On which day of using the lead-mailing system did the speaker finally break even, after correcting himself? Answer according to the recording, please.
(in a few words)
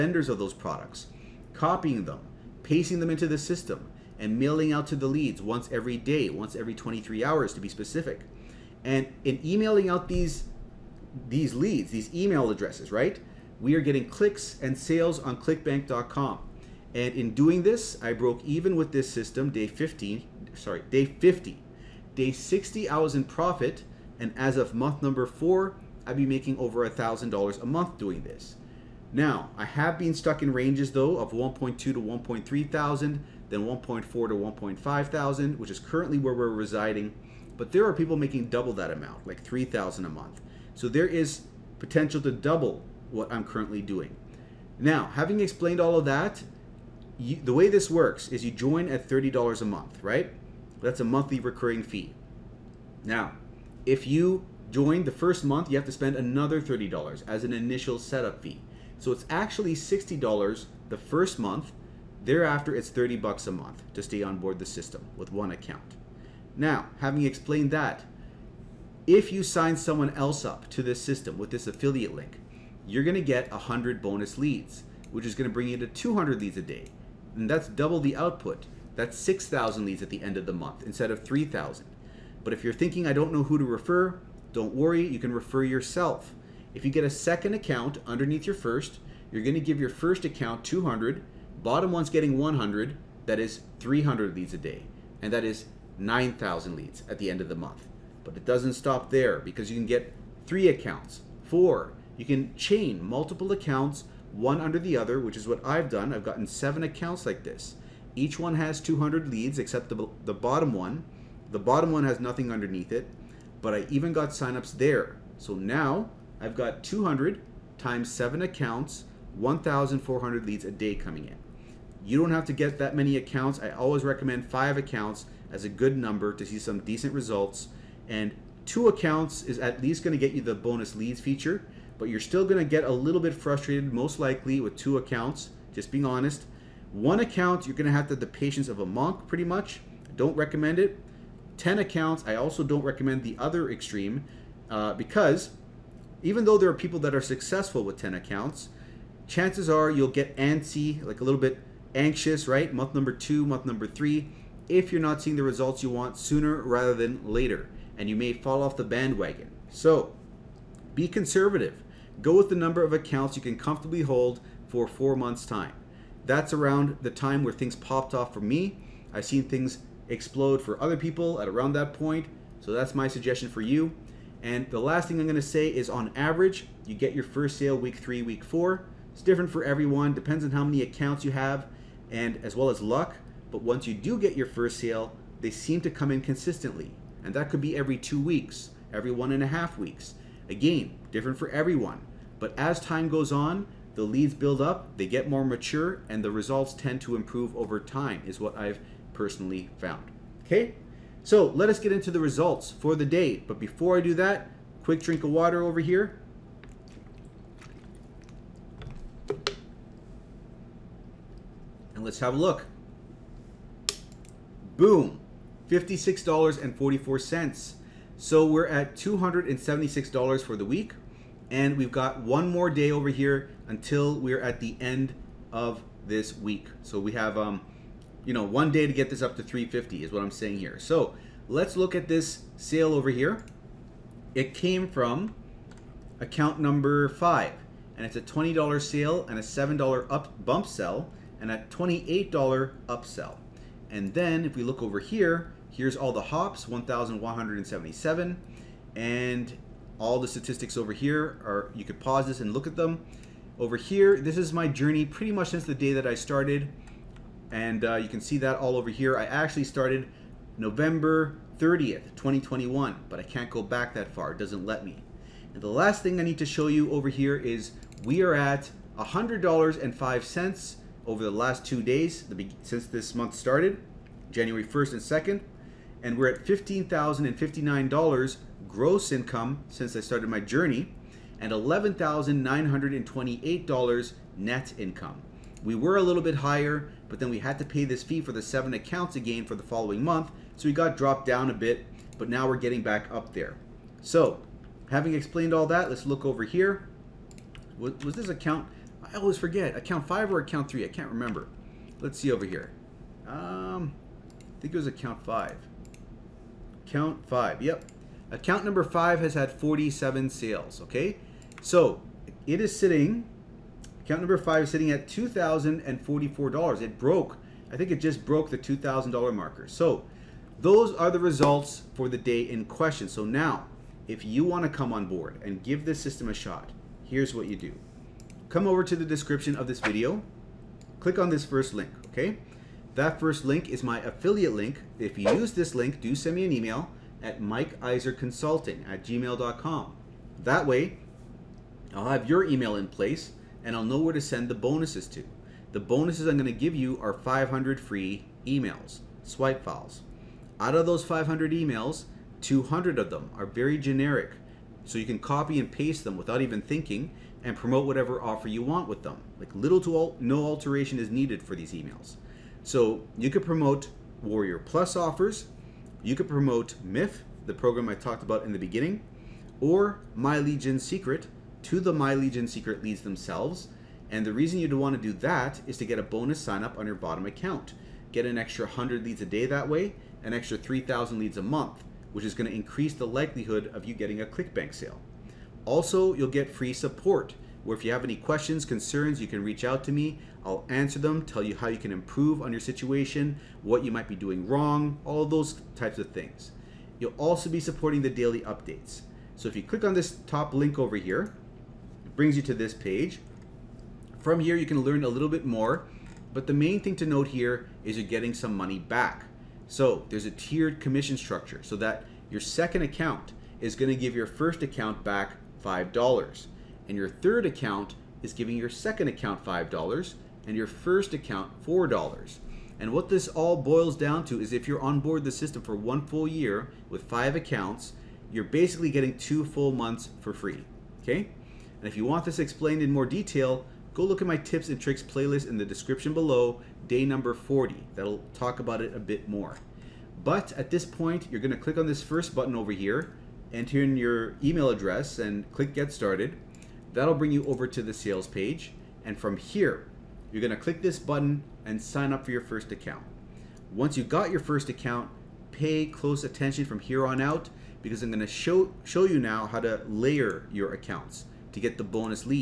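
Day 50.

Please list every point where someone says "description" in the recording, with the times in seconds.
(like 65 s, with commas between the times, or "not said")
329 s, 435 s.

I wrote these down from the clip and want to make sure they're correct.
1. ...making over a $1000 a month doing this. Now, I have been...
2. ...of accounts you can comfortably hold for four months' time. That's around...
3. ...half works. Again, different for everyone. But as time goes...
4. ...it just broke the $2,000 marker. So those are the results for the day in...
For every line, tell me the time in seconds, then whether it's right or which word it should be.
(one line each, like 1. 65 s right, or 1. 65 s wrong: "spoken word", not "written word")
1. 26 s right
2. 162 s right
3. 189 s wrong: "weeks", not "works"
4. 317 s right.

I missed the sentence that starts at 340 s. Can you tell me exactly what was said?
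That way, I'll have your email in place and I'll know where to send the bonuses to.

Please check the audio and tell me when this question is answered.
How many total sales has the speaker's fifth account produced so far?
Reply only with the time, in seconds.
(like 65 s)
309 s.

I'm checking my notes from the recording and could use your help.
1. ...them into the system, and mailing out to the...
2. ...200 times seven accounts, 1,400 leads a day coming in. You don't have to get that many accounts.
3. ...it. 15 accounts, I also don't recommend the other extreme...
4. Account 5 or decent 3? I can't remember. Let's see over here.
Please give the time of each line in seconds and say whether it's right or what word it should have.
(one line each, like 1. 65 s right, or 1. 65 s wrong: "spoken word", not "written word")
1. 3 s right
2. 116 s right
3. 140 s wrong: "10", not "15"
4. 299 s wrong: "account", not "decent".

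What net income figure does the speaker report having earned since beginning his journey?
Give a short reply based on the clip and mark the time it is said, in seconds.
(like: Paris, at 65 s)
$11,928, at 281 s.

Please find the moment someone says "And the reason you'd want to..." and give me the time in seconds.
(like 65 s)
374 s.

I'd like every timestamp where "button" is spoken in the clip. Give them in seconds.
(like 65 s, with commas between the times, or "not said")
442 s, 450 s.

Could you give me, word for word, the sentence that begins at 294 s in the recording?
So, having explained all that, let's look over here.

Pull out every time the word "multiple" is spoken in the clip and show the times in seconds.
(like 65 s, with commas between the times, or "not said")
103 s.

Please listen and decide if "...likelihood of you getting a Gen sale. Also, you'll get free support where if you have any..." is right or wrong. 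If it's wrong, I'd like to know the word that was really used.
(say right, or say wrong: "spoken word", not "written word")
wrong: "ClickBank", not "Gen".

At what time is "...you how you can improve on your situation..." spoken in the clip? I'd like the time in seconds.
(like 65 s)
391 s.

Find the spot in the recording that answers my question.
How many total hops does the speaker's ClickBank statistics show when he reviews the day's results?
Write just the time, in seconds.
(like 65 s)
246 s.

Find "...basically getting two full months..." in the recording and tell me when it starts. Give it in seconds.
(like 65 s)
428 s.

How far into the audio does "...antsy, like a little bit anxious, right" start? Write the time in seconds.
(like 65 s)
150 s.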